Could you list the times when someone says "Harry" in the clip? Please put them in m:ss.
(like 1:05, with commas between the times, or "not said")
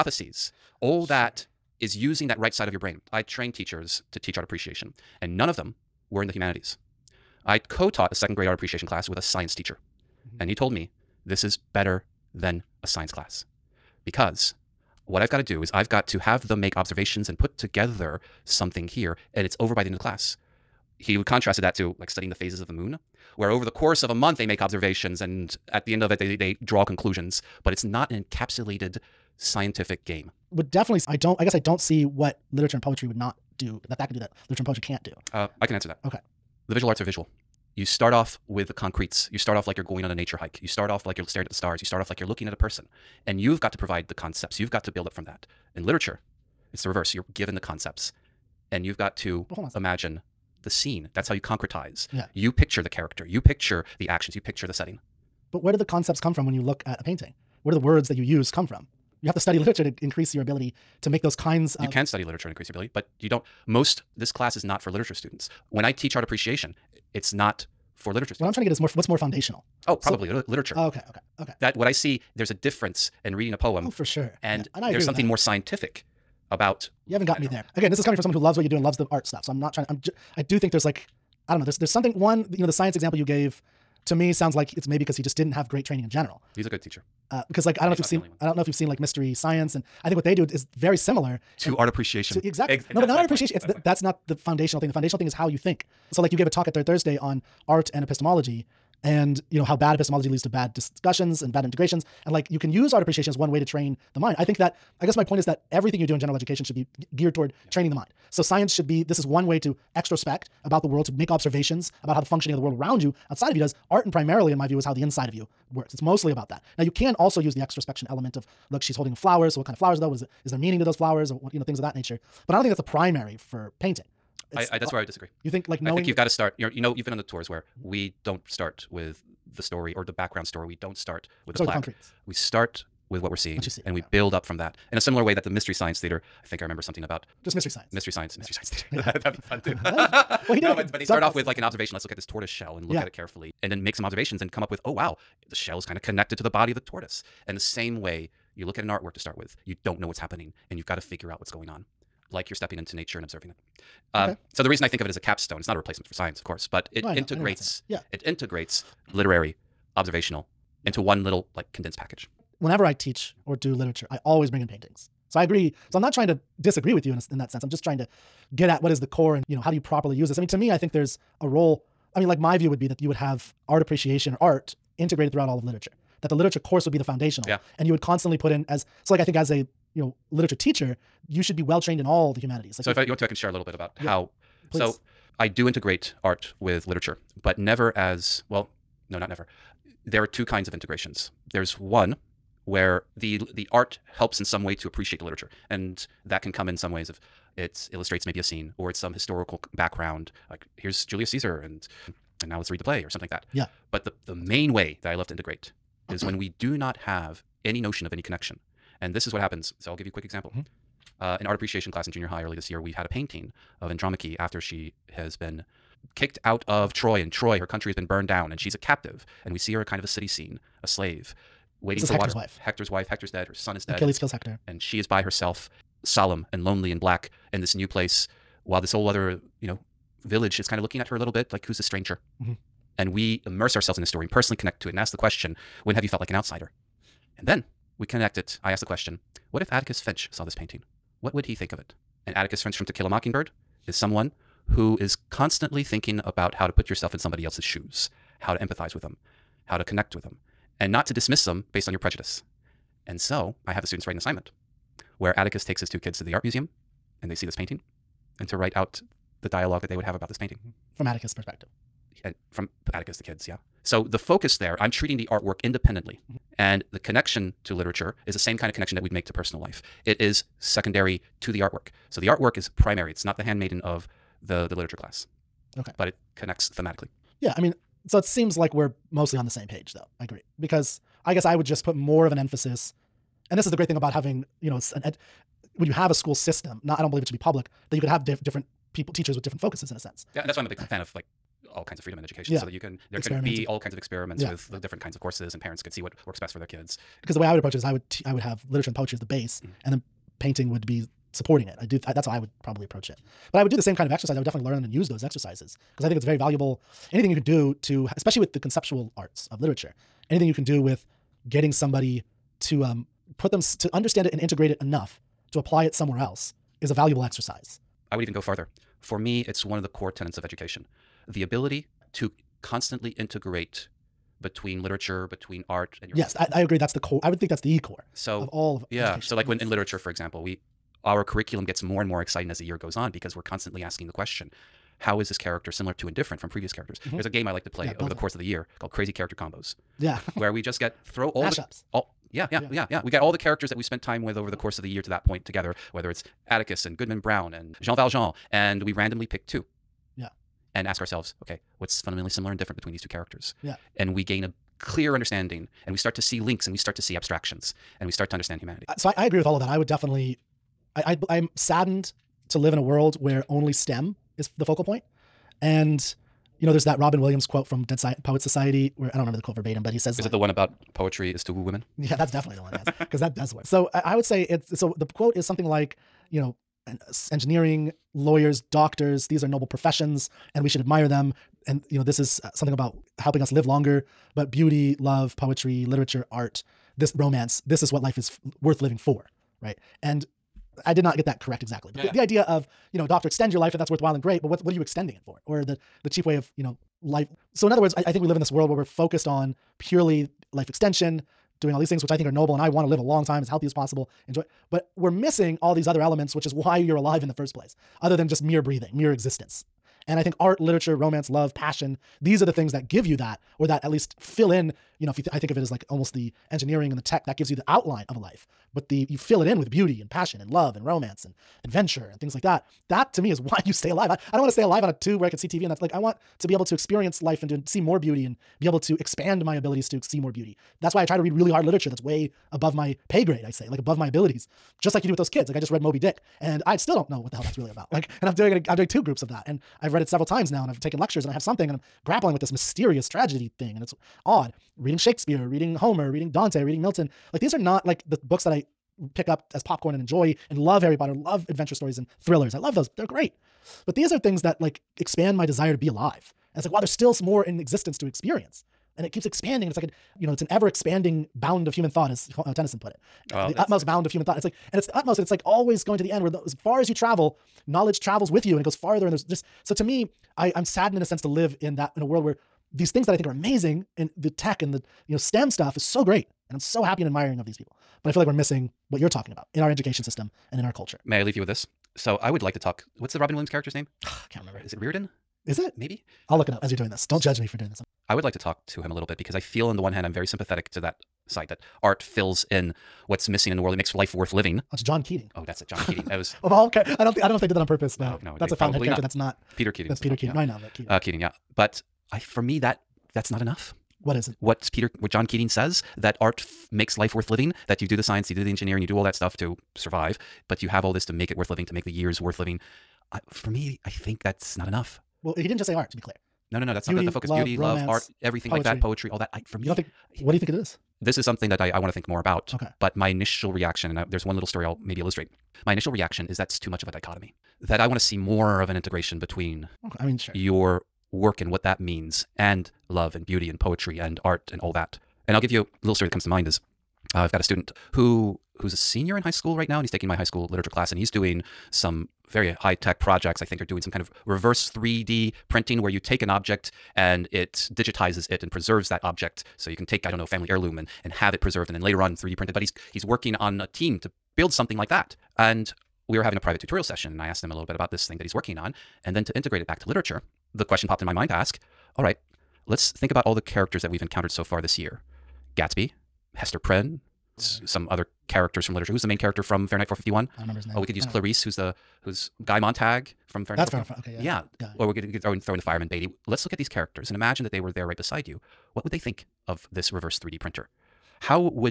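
7:30.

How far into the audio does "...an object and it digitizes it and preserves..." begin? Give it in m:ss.
9:06.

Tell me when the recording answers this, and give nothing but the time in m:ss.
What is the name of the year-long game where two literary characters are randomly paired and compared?
5:38.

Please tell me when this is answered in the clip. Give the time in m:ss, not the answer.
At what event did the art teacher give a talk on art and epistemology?
1:36.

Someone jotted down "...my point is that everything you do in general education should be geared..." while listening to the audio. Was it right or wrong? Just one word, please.
right.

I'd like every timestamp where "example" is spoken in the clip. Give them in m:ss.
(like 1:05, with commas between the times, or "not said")
1:22, 3:30, 5:30.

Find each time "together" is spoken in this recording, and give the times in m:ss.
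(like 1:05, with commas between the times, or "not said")
0:17, 5:45.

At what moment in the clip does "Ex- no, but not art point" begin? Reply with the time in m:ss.
1:32.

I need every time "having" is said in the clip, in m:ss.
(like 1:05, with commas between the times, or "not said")
4:44, 9:16.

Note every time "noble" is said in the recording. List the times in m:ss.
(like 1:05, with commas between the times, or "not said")
6:19, 6:42.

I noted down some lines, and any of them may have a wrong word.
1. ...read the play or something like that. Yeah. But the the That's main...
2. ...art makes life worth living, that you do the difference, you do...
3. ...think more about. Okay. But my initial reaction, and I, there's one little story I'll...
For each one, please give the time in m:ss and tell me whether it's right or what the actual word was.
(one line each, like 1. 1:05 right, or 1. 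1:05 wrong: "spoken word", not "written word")
1. 3:22 right
2. 8:26 wrong: "science", not "difference"
3. 8:41 right.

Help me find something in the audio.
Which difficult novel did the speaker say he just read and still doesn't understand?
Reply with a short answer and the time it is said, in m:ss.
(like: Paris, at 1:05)
Moby Dick, at 7:15.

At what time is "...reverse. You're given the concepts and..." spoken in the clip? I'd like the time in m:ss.
0:46.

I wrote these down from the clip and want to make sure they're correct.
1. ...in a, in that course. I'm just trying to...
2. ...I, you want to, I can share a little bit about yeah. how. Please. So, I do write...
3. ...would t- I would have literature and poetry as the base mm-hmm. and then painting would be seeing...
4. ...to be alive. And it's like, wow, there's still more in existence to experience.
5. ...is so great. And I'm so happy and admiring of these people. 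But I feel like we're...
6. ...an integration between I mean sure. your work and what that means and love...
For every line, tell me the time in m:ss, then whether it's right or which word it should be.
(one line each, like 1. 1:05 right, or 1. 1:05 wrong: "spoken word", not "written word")
1. 2:47 wrong: "sense", not "course"
2. 3:02 wrong: "integrate", not "write"
3. 4:57 wrong: "supporting", not "seeing"
4. 7:35 right
5. 7:55 right
6. 8:48 right.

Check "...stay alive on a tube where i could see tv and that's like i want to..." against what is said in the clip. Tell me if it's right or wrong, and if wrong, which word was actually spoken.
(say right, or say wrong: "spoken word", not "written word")
right.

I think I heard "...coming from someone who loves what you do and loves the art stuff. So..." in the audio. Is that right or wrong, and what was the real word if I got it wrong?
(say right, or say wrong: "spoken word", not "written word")
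right.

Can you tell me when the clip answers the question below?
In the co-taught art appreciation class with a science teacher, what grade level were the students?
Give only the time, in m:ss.
0:08.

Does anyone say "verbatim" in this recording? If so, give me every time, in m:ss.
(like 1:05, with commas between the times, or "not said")
6:09.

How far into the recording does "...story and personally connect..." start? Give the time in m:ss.
3:54.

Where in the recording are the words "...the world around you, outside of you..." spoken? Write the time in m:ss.
1:52.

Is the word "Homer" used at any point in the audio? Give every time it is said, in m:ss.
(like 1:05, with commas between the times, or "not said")
7:25.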